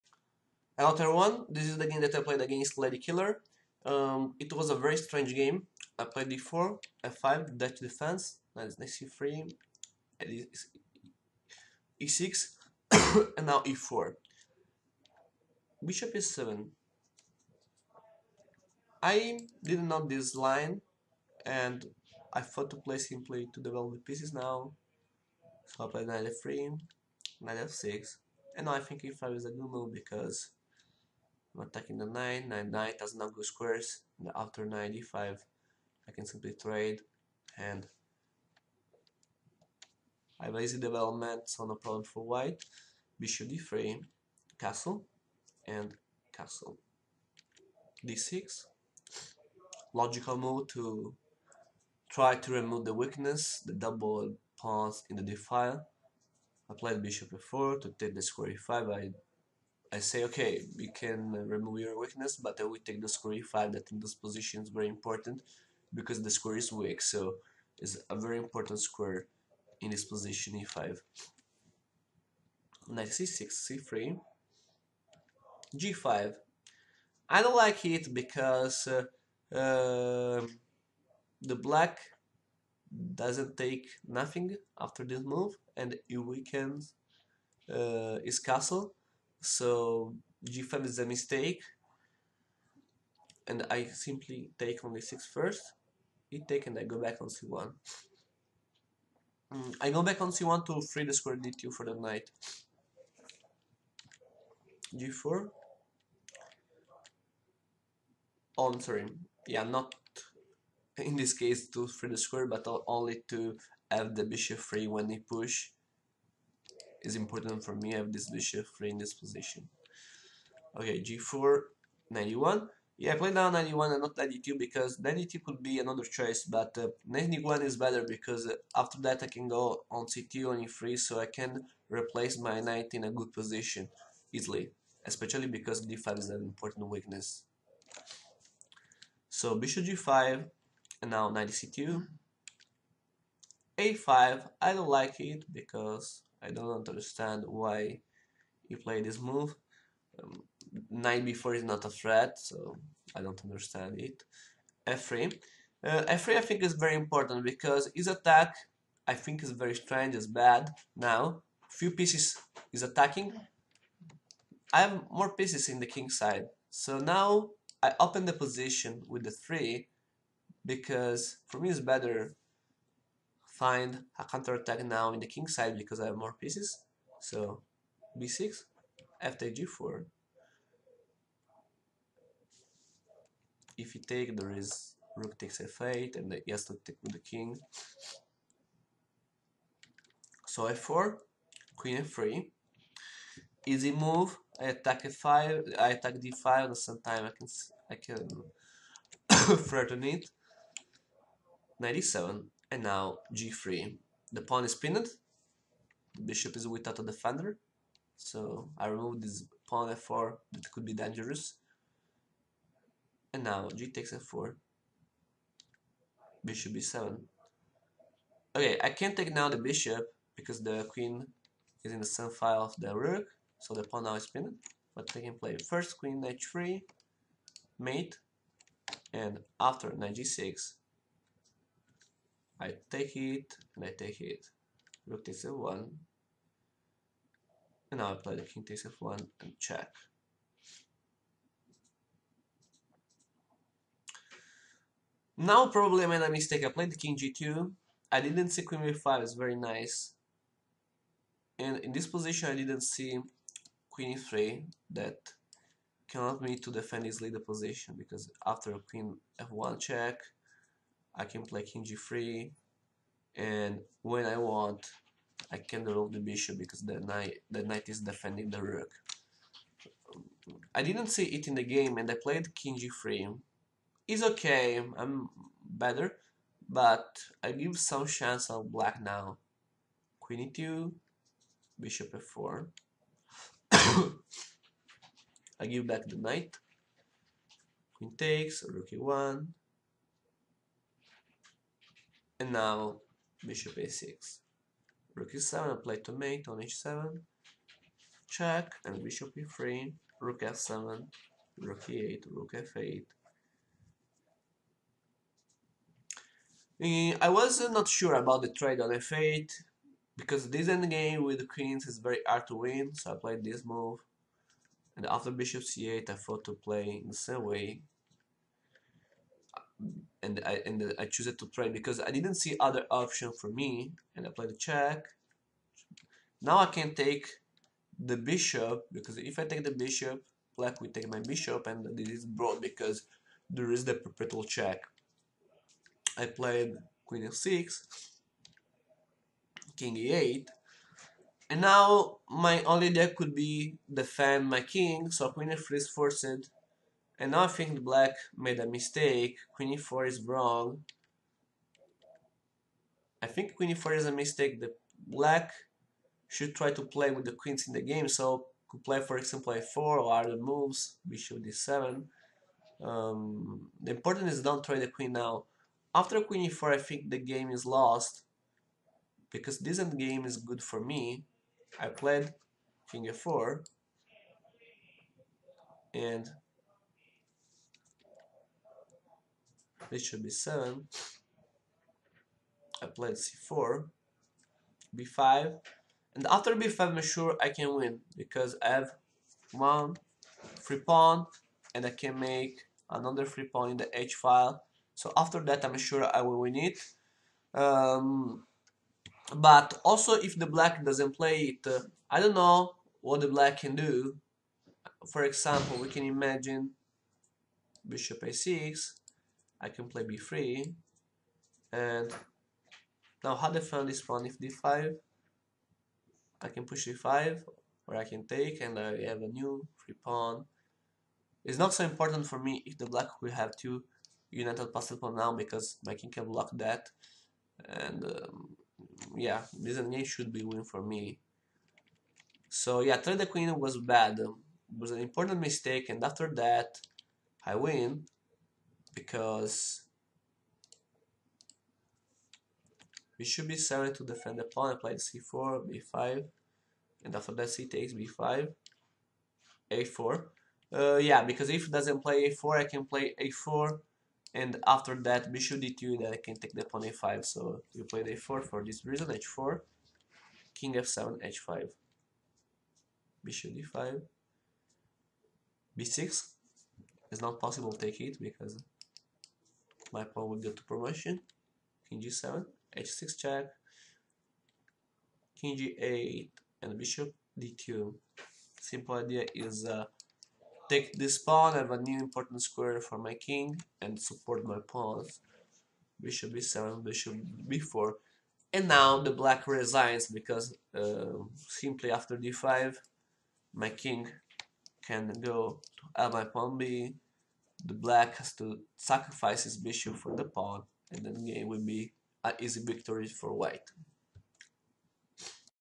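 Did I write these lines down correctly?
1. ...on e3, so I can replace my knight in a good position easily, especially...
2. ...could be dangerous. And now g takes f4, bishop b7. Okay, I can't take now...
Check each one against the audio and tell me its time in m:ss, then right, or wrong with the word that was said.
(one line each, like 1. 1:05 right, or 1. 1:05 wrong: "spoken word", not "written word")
1. 2:10 right
2. 3:30 right.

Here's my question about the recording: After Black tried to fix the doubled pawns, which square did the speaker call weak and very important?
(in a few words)
e5.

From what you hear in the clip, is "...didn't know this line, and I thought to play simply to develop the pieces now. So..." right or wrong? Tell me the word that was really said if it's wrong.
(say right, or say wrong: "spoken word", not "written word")
right.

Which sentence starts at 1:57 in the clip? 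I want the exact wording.
I have this bishop free in this position.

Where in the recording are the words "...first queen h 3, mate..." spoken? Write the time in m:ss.
3:45.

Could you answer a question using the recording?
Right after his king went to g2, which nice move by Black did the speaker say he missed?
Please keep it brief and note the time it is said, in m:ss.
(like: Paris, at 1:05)
Queen b5, at 4:08.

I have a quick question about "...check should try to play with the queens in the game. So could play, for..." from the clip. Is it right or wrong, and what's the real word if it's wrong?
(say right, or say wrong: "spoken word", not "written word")
wrong: "black", not "check".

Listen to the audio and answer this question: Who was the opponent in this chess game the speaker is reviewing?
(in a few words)
Ladykiller.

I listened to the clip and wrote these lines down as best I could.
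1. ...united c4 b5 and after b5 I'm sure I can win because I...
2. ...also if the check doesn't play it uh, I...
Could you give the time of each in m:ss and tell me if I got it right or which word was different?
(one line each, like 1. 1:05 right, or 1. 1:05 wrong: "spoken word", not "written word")
1. 6:22 wrong: "played", not "united"
2. 6:39 wrong: "black", not "check".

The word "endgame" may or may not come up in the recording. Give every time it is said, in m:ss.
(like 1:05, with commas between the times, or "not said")
5:10, 6:09.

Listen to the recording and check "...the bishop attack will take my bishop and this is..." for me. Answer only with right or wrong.
wrong.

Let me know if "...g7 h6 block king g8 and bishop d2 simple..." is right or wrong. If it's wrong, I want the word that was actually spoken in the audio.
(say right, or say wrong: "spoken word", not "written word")
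wrong: "check", not "block".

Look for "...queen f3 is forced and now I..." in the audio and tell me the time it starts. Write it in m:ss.
5:45.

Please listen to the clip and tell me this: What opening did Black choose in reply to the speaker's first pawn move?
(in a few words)
Dutch defense.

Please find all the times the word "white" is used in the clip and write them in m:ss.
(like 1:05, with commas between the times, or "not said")
0:42, 8:23.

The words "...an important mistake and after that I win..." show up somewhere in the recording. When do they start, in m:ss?
7:14.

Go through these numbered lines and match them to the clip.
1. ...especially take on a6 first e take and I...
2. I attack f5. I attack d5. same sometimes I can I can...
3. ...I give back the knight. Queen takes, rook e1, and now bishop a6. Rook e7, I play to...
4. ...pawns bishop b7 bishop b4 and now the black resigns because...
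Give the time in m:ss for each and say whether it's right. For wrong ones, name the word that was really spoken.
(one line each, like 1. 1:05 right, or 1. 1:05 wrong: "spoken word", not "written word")
1. 1:33 wrong: "simply", not "especially"
2. 3:14 right
3. 4:45 right
4. 8:04 right.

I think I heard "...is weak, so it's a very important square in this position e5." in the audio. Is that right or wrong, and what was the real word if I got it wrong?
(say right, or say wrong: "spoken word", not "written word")
right.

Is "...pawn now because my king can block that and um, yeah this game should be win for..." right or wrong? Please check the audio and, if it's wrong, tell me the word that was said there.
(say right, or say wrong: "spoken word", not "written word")
right.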